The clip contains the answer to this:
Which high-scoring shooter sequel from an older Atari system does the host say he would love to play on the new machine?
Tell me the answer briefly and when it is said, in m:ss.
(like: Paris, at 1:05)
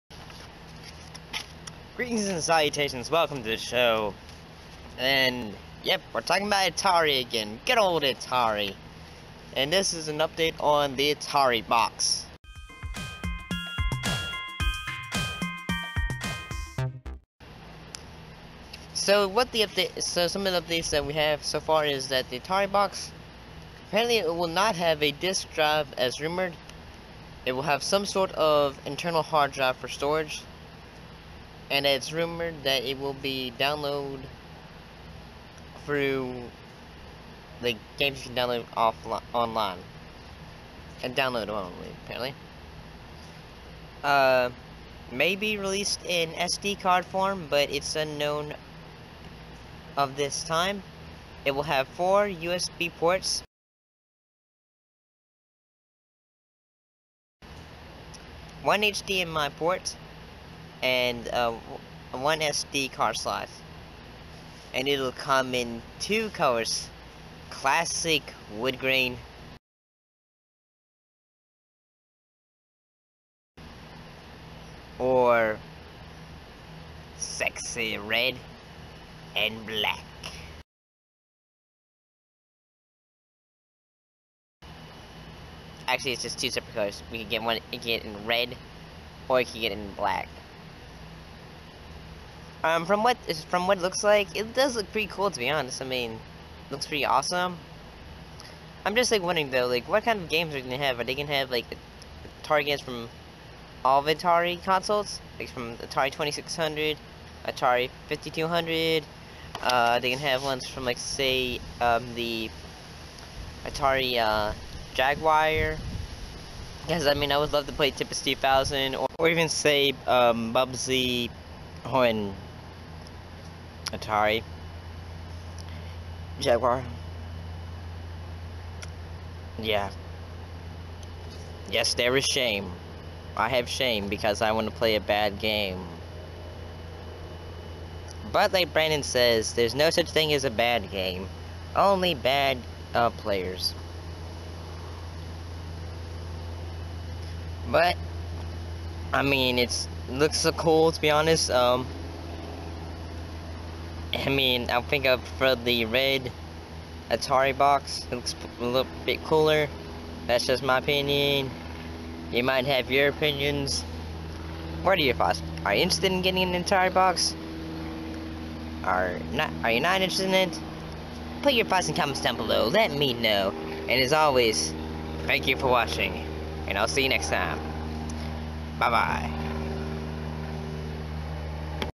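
Tempest 2000, at 1:57.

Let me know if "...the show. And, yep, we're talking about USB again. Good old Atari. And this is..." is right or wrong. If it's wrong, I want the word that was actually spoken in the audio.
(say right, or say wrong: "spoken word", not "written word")
wrong: "Atari", not "USB".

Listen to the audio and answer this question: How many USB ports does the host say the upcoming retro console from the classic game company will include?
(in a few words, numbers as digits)
4.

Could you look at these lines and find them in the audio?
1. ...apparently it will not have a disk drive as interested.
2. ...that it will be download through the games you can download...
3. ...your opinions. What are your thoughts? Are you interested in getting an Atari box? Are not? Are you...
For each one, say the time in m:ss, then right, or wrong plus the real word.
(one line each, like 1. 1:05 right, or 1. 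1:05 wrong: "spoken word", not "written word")
1. 0:23 wrong: "rumored", not "interested"
2. 0:32 right
3. 2:42 right.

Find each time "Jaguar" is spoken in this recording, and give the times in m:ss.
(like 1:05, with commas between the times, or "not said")
1:54, 2:06.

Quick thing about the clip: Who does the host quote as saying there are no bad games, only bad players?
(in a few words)
Brandon.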